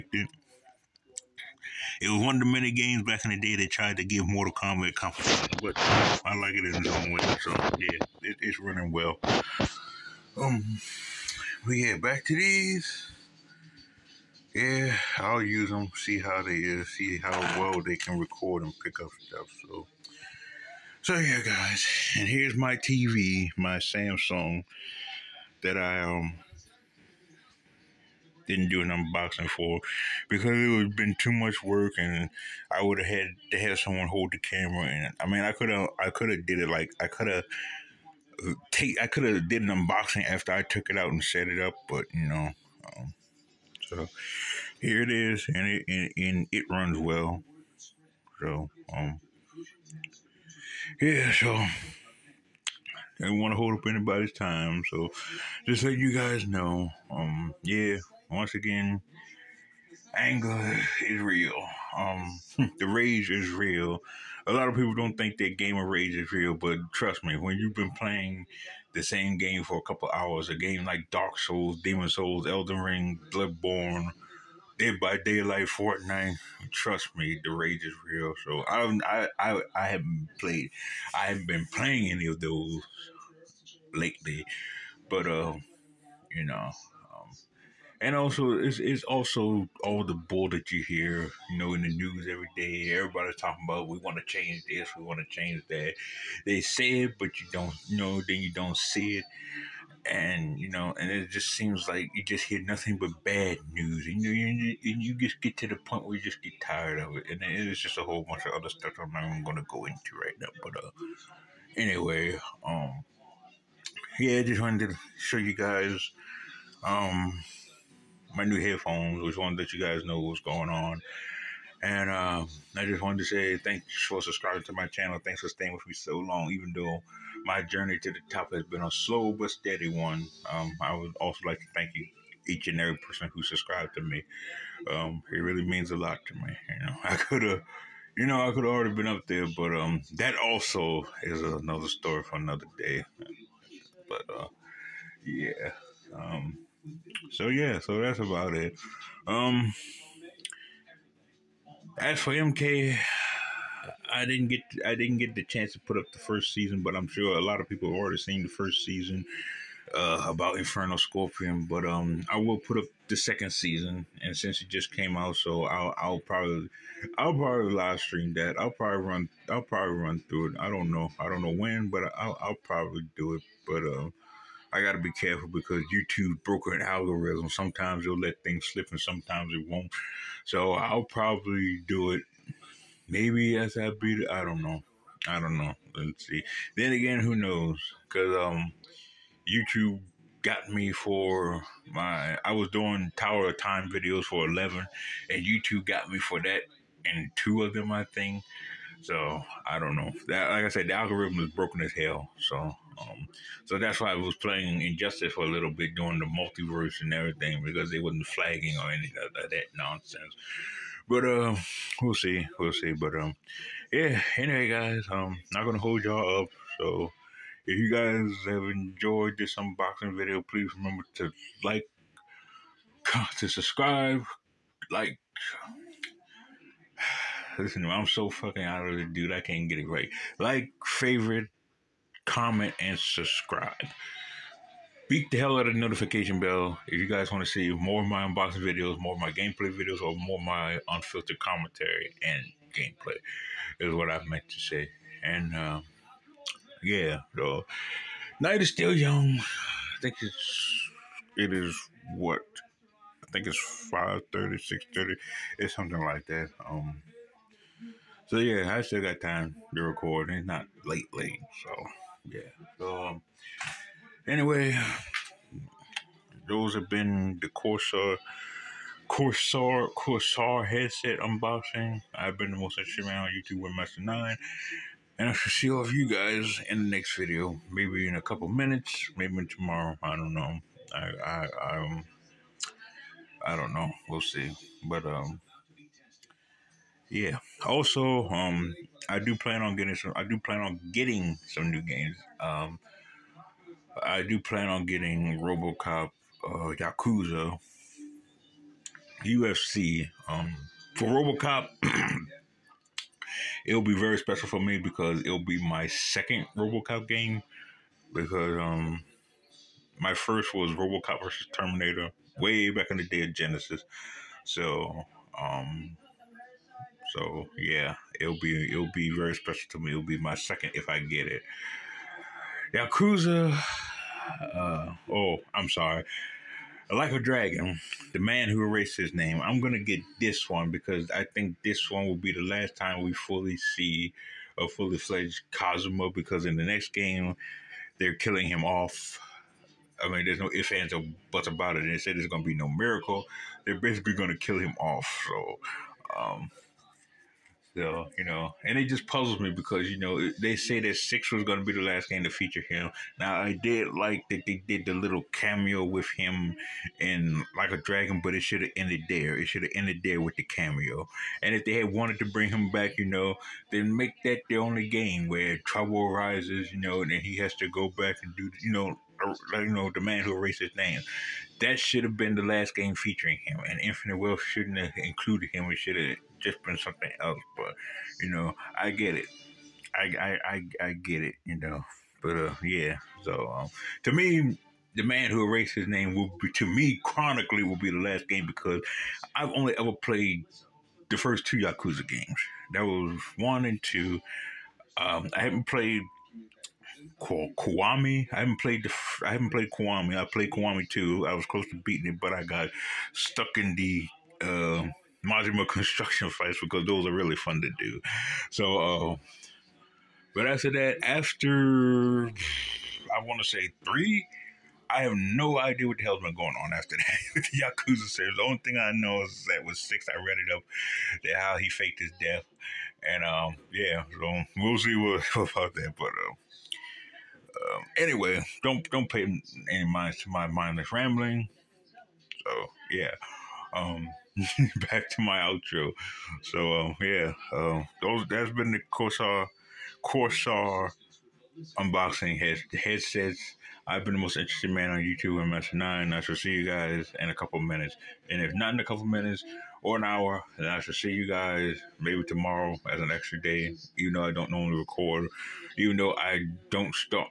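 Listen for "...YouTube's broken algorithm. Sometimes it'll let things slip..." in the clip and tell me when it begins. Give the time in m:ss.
2:55.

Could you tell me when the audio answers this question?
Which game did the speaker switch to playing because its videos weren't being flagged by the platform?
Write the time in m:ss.
3:24.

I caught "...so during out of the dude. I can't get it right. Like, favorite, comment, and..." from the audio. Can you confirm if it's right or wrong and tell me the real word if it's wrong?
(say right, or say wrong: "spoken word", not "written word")
wrong: "fucking", not "during".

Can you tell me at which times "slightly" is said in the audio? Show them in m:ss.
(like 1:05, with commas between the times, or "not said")
not said.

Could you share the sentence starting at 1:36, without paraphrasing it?
They say it, but you don't you know.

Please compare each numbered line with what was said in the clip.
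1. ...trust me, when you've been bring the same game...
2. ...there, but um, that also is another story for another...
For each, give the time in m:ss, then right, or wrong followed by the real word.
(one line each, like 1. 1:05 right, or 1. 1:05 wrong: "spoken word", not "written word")
1. 1:06 wrong: "playing", not "bring"
2. 2:19 right.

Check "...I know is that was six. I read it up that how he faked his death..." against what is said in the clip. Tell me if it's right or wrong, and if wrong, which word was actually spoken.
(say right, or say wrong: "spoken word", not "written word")
right.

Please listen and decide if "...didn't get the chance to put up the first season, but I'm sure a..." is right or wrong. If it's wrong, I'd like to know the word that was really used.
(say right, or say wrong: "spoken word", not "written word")
right.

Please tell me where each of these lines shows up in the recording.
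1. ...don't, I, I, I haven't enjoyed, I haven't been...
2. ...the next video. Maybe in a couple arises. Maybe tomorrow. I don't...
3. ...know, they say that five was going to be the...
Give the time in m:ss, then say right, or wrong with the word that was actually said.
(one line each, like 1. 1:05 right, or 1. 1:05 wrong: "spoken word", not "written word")
1. 1:18 wrong: "played", not "enjoyed"
2. 4:36 wrong: "minutes", not "arises"
3. 5:49 wrong: "six", not "five".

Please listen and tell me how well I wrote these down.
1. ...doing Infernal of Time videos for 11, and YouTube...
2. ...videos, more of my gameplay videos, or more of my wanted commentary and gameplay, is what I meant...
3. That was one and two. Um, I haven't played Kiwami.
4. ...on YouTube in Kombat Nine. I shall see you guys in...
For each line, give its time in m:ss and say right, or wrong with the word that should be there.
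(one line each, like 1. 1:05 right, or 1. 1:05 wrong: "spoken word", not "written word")
1. 3:12 wrong: "Tower", not "Infernal"
2. 3:58 wrong: "unfiltered", not "wanted"
3. 6:32 right
4. 7:24 wrong: "Master", not "Kombat".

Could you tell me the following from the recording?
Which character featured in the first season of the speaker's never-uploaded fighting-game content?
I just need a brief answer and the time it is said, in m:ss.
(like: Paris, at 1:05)
Infernal Scorpion, at 2:40.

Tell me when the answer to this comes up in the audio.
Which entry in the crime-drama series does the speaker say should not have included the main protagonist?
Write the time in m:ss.
6:13.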